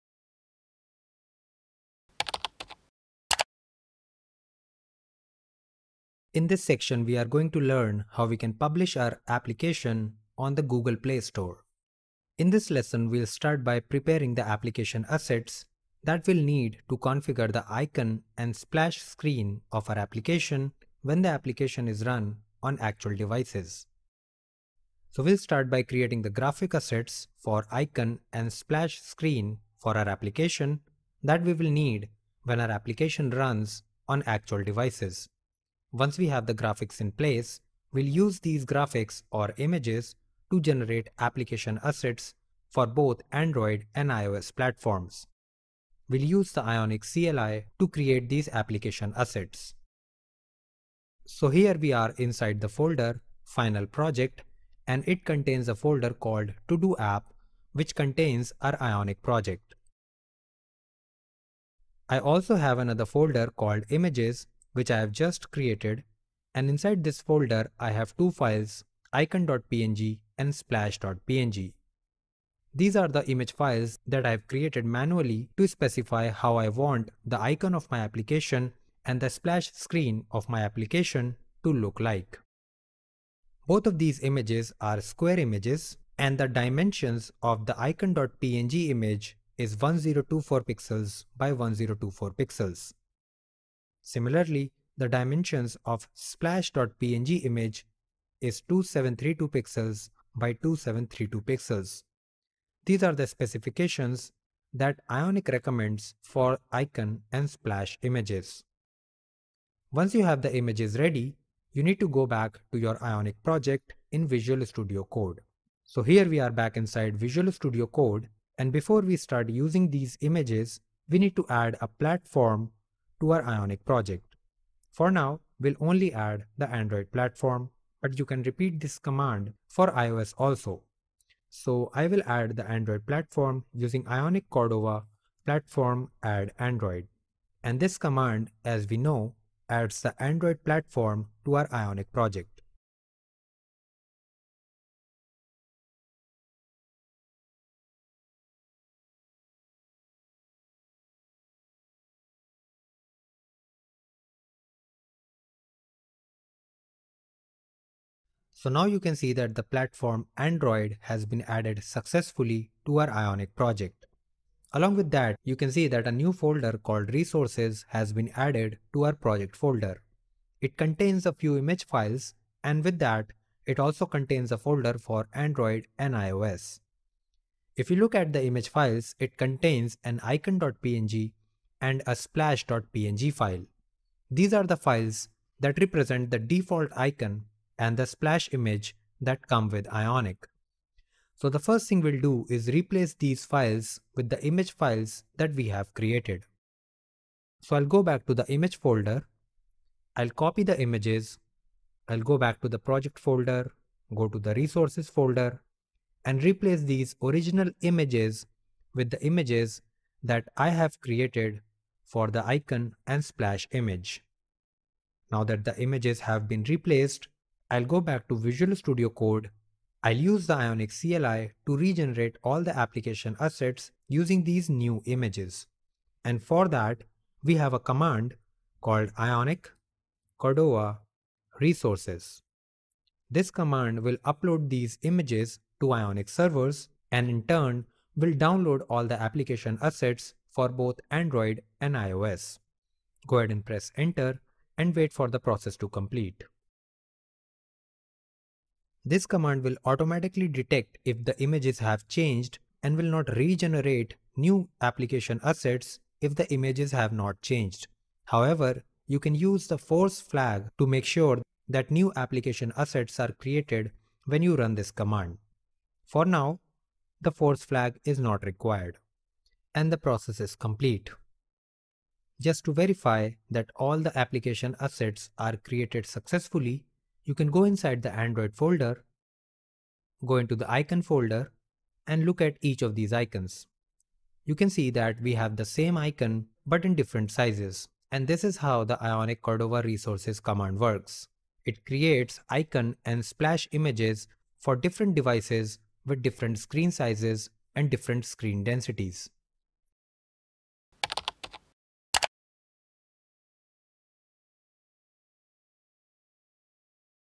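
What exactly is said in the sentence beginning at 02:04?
For now, we'll only add the Android platform, but you can repeat this command for iOS also.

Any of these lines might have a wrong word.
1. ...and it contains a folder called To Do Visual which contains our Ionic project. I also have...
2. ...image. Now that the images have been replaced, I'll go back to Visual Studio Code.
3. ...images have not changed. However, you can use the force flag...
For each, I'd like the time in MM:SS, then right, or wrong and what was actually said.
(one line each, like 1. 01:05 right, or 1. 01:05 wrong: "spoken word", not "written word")
1. 00:54 wrong: "App", not "Visual"
2. 03:33 right
3. 04:16 right.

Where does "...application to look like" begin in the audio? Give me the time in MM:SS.
01:20.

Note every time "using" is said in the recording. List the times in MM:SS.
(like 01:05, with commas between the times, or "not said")
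01:59, 02:13, 03:44.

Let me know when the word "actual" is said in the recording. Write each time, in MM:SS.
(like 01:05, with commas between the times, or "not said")
00:22, 00:34.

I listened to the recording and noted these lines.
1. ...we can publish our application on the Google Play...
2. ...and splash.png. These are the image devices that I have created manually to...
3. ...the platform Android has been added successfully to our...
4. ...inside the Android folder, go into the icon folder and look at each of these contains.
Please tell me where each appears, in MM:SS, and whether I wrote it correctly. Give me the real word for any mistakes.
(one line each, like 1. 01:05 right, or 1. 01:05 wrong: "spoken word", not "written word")
1. 00:08 right
2. 01:10 wrong: "files", not "devices"
3. 02:39 right
4. 04:37 wrong: "icons", not "contains".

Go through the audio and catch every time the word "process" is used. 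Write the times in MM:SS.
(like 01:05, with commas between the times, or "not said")
04:05, 04:29.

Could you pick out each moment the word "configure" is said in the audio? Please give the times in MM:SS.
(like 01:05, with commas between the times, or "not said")
00:16.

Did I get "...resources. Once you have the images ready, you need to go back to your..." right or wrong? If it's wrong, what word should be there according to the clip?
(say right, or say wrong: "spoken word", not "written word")
wrong: "images", not "resources".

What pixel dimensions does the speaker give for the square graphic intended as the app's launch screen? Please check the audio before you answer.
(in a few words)
2732 by 2732 pixels.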